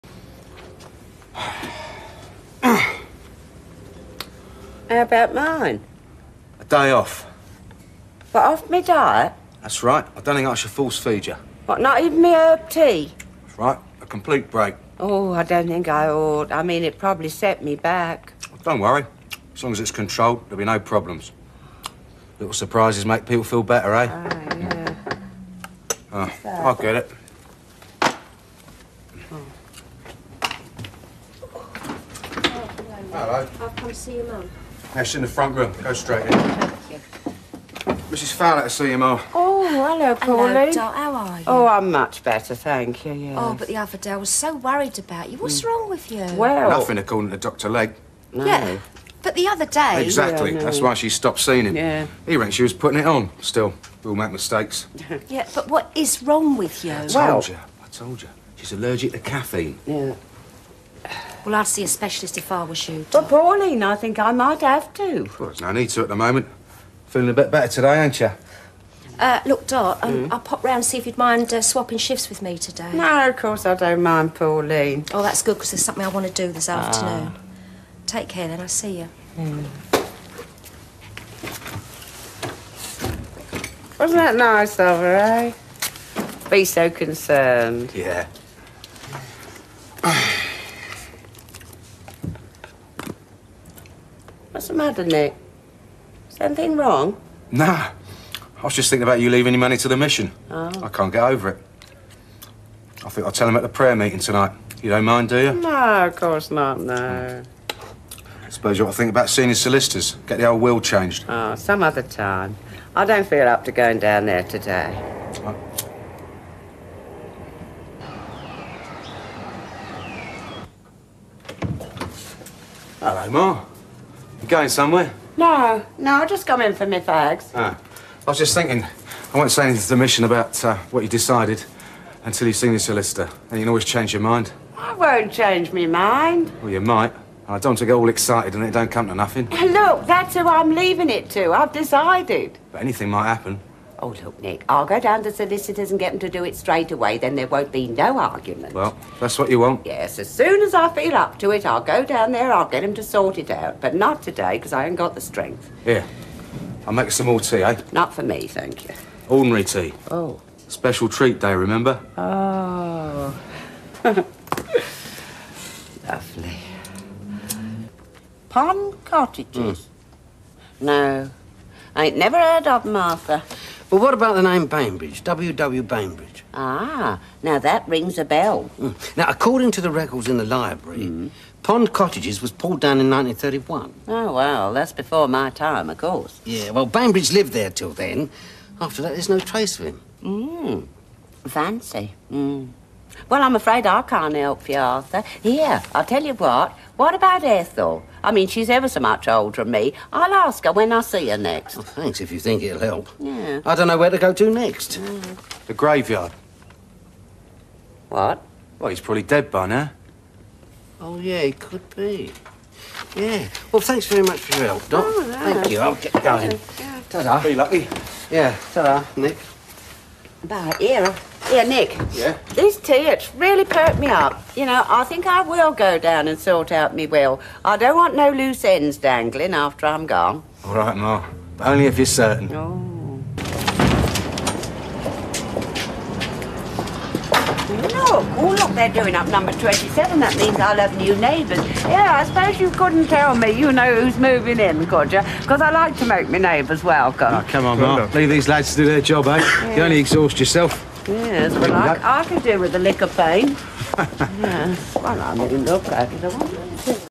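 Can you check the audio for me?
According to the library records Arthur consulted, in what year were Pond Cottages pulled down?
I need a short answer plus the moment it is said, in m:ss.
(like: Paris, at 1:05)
1931, at 3:03.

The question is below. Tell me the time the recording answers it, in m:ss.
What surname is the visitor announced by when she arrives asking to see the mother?
0:38.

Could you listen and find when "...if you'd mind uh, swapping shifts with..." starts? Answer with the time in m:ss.
1:10.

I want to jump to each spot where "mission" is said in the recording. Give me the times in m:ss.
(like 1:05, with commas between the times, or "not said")
1:39, 2:09.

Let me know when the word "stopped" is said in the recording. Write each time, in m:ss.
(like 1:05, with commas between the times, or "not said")
0:51.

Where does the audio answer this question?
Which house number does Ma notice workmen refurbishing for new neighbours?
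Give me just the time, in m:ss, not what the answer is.
3:59.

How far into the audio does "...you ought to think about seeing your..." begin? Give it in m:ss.
1:48.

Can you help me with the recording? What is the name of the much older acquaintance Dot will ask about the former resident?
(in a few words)
Ethel.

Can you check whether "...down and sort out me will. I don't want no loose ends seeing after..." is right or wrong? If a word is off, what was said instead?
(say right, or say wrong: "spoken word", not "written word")
wrong: "dangling", not "seeing".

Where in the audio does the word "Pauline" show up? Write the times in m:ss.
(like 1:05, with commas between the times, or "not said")
0:40, 1:03, 1:14.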